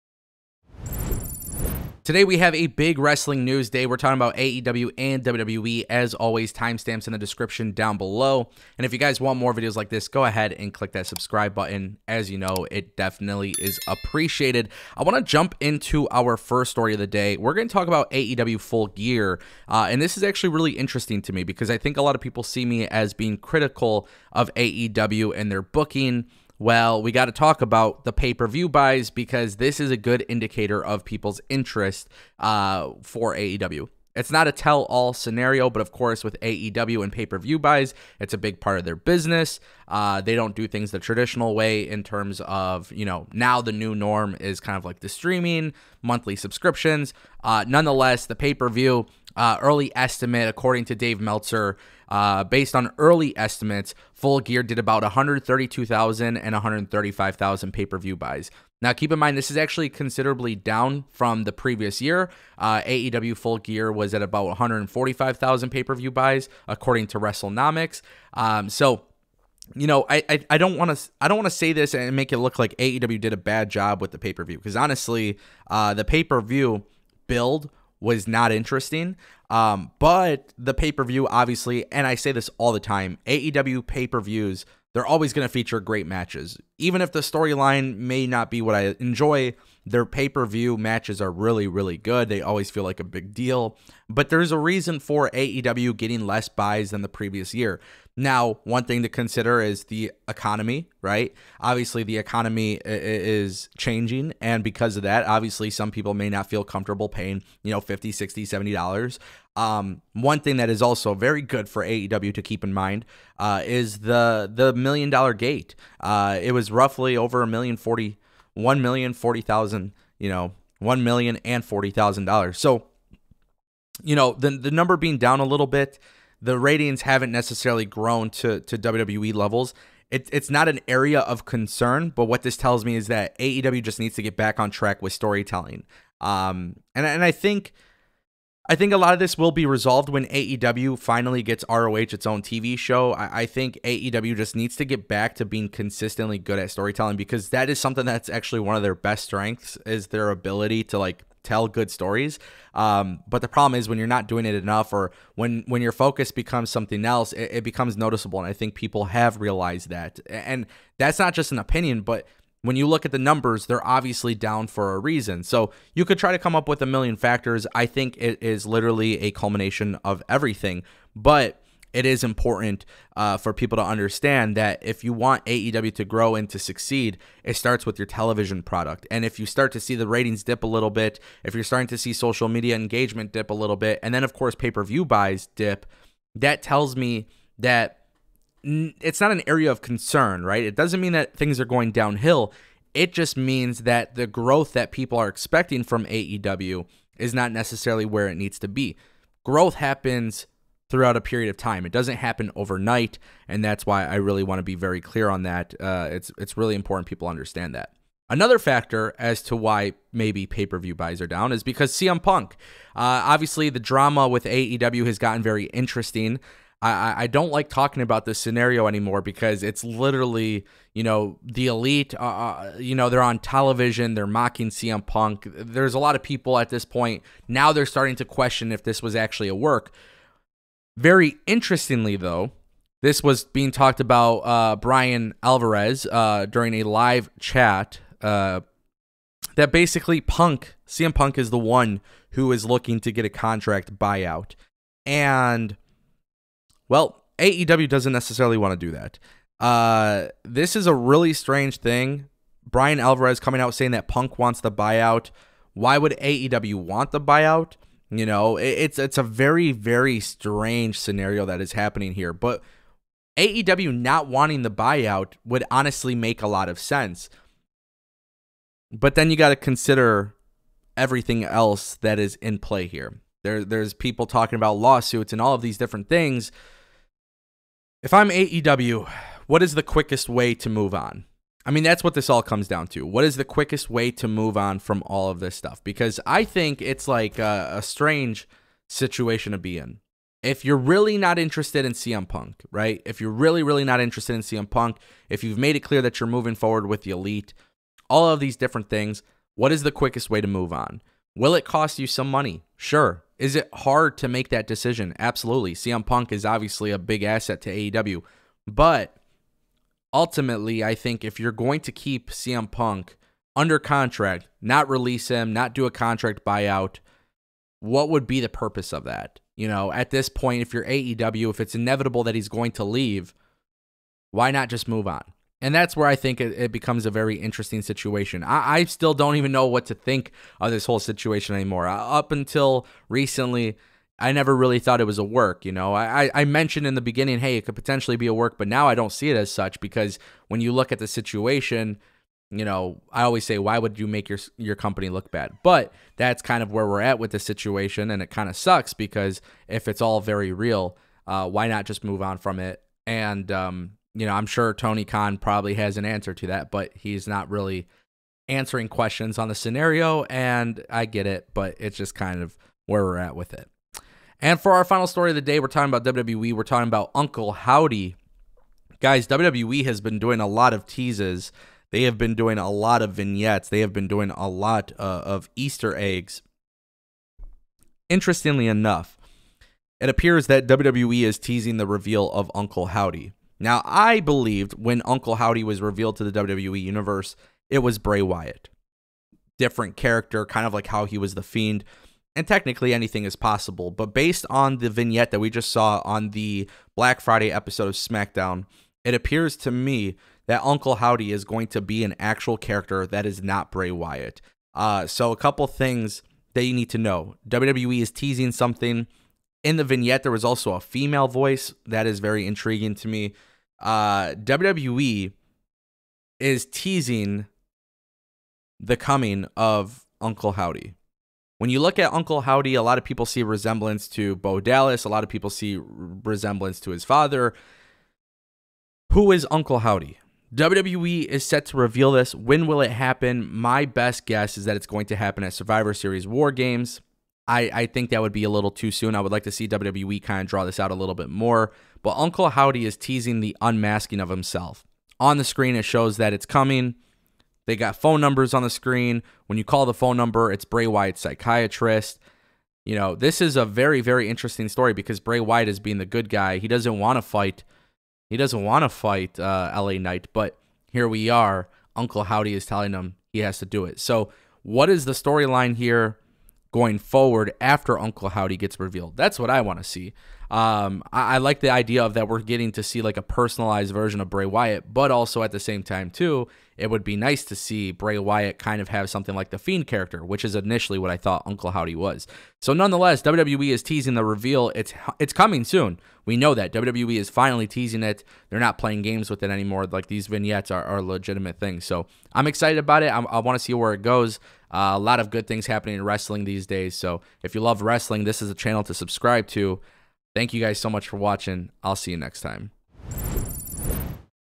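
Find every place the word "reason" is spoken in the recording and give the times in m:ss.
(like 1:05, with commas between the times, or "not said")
1:34, 2:44.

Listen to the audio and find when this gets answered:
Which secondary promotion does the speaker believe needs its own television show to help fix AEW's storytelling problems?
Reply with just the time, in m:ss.
2:21.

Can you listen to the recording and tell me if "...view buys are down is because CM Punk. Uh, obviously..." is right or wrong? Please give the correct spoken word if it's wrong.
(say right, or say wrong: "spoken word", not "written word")
right.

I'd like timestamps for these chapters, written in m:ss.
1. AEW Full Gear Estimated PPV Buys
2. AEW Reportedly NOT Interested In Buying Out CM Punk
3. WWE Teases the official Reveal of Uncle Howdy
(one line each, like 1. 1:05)
1. 0:17
2. 3:31
3. 6:04.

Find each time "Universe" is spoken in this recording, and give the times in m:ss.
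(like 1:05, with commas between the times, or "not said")
6:26.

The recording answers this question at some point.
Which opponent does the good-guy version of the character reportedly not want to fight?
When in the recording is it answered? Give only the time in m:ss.
7:39.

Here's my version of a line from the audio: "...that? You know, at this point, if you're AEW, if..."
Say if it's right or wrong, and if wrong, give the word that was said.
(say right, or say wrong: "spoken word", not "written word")
right.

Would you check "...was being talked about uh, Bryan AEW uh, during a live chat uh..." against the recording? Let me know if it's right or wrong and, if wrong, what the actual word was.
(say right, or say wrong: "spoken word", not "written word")
wrong: "Alvarez", not "AEW".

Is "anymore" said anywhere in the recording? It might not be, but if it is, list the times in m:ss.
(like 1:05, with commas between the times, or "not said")
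3:38, 5:31, 8:09.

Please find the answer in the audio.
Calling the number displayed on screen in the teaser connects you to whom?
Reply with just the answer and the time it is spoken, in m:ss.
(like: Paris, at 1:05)
Bray Wyatt's psychiatrist, at 7:30.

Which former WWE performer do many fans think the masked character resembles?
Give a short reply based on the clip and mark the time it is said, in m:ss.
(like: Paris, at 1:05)
Bo Dallas, at 7:04.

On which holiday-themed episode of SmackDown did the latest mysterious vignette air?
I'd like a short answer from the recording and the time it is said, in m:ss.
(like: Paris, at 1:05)
Black Friday, at 6:36.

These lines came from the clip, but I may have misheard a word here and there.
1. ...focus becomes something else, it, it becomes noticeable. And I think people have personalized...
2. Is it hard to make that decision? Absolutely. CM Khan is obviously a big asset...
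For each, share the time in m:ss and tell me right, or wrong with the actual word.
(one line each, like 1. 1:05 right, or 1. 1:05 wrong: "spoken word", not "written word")
1. 2:35 wrong: "realized", not "personalized"
2. 5:03 wrong: "Punk", not "Khan".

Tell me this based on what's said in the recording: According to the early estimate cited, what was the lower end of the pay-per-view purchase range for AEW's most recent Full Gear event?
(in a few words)
132,000.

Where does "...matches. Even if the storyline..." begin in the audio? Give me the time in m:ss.
1:26.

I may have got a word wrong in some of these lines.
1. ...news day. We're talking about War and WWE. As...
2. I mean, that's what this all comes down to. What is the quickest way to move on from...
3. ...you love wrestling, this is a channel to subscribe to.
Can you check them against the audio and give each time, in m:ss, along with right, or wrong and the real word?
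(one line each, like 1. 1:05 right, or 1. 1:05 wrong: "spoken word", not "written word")
1. 0:03 wrong: "AEW", not "War"
2. 4:41 right
3. 8:17 right.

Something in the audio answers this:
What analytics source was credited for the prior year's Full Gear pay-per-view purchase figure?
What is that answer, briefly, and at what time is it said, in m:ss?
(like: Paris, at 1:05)
WrestleNomics, at 1:07.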